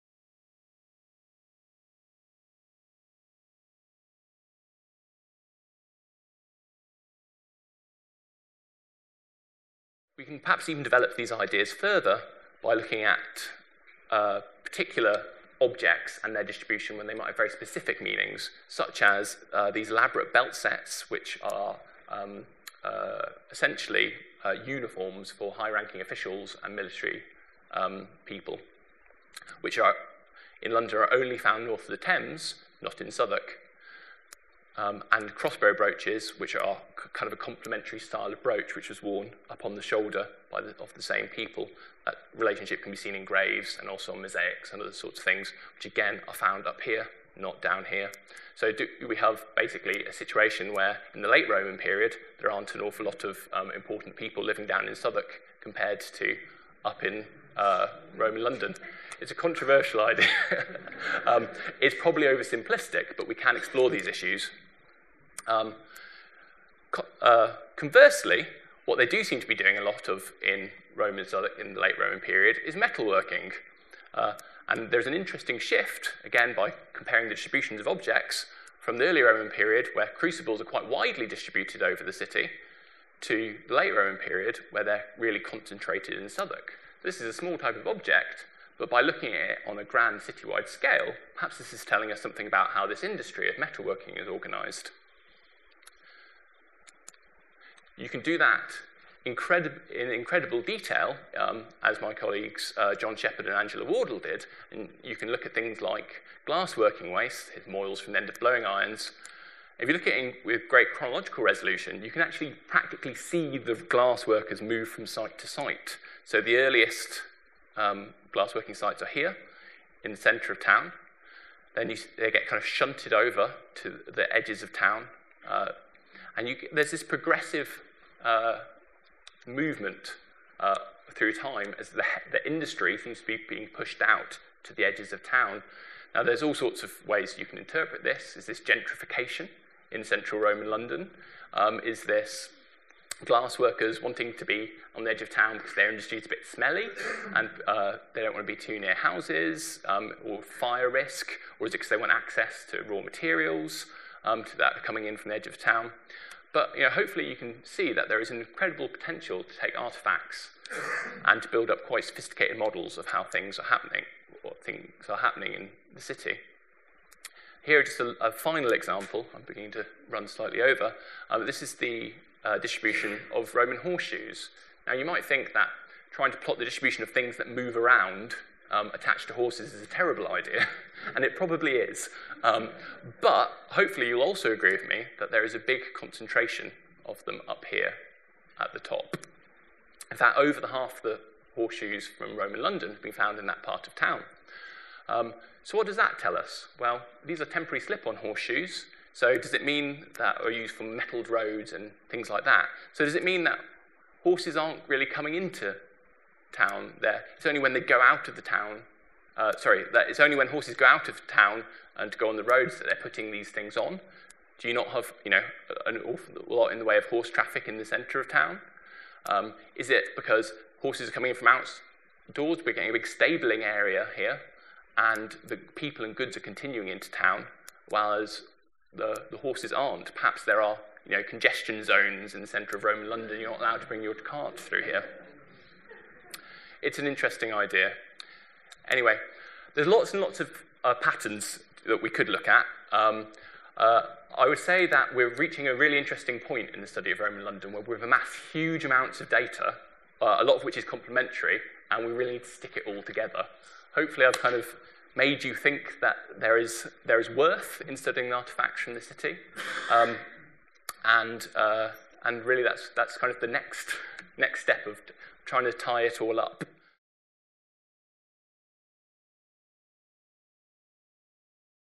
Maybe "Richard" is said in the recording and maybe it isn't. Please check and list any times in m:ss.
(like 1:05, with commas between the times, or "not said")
not said.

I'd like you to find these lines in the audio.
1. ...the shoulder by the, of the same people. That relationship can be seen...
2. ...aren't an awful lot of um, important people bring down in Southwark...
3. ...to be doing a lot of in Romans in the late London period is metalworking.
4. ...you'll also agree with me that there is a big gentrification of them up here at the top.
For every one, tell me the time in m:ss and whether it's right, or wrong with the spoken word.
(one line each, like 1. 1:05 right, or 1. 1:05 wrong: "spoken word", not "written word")
1. 0:39 right
2. 0:52 wrong: "living", not "bring"
3. 1:09 wrong: "Roman", not "London"
4. 3:04 wrong: "concentration", not "gentrification".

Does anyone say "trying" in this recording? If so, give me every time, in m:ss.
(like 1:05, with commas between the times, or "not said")
2:56, 4:25.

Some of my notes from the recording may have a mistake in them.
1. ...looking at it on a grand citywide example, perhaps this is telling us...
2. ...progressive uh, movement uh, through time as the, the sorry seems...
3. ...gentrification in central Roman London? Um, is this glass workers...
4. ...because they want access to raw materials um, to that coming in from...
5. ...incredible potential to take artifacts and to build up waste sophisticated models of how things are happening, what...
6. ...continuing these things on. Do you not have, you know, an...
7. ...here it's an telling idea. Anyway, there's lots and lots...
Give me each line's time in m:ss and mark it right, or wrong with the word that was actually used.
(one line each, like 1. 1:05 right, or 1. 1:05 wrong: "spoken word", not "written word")
1. 1:29 wrong: "scale", not "example"
2. 2:07 wrong: "industry", not "sorry"
3. 2:18 right
4. 2:31 right
5. 2:38 wrong: "quite", not "waste"
6. 3:33 wrong: "putting", not "continuing"
7. 3:54 wrong: "interesting", not "telling".